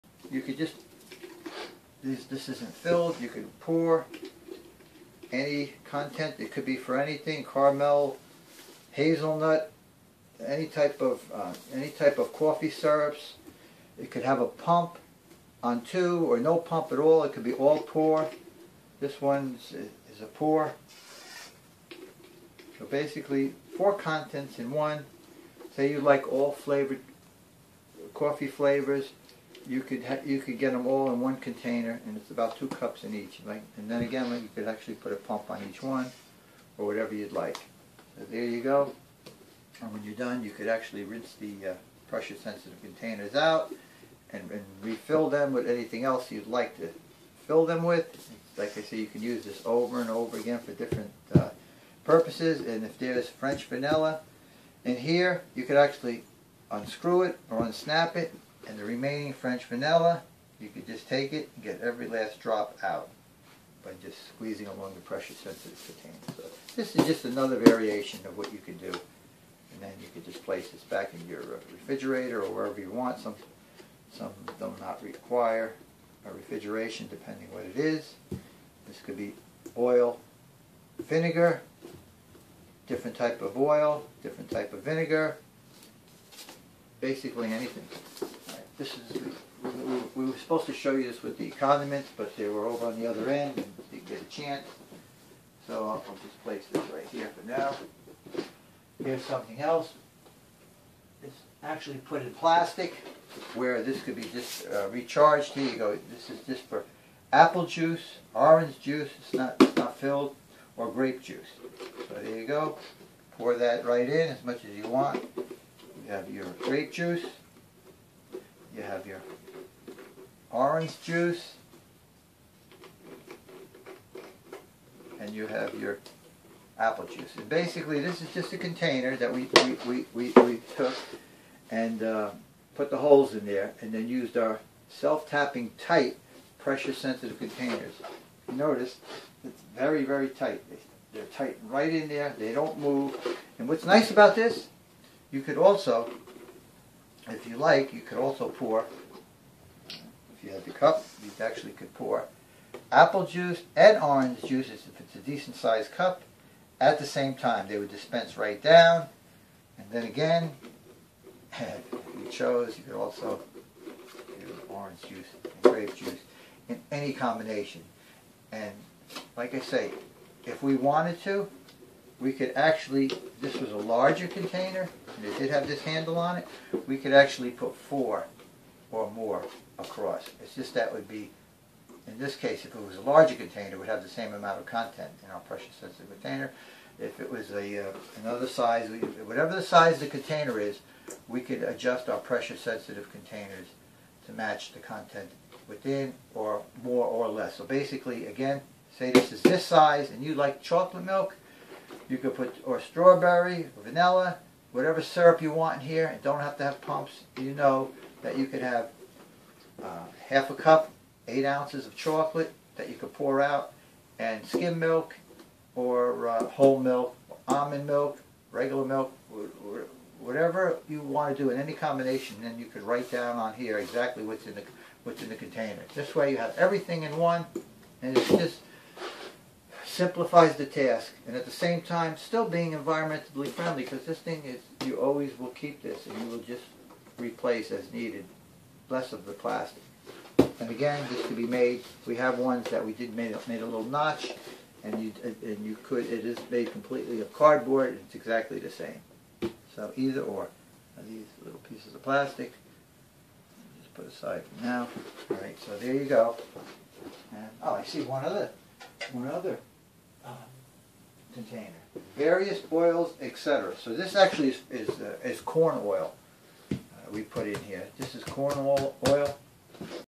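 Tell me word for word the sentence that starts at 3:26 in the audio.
And don't have to have pumps.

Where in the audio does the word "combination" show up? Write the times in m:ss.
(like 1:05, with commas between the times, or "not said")
2:47, 3:41.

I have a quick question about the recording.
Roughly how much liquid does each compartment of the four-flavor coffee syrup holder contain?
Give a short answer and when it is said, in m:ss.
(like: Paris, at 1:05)
2 cups, at 0:32.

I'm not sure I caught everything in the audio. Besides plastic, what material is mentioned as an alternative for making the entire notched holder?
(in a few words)
Cardboard.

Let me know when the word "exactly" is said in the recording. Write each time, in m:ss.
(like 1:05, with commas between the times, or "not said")
3:43, 4:08.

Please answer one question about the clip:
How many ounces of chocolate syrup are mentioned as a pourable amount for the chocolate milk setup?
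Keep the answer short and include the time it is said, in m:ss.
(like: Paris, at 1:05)
8 ounces, at 3:31.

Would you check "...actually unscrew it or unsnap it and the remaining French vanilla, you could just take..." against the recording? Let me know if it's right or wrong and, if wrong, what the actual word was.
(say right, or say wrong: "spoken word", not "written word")
right.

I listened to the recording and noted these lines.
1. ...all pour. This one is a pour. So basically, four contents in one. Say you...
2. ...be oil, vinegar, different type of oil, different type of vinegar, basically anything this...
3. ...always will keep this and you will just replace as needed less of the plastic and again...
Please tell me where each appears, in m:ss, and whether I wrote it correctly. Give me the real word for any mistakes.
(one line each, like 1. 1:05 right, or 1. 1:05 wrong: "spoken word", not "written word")
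1. 0:17 right
2. 1:19 right
3. 3:54 right.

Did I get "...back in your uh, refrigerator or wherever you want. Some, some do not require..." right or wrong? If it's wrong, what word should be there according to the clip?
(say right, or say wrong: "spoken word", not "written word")
right.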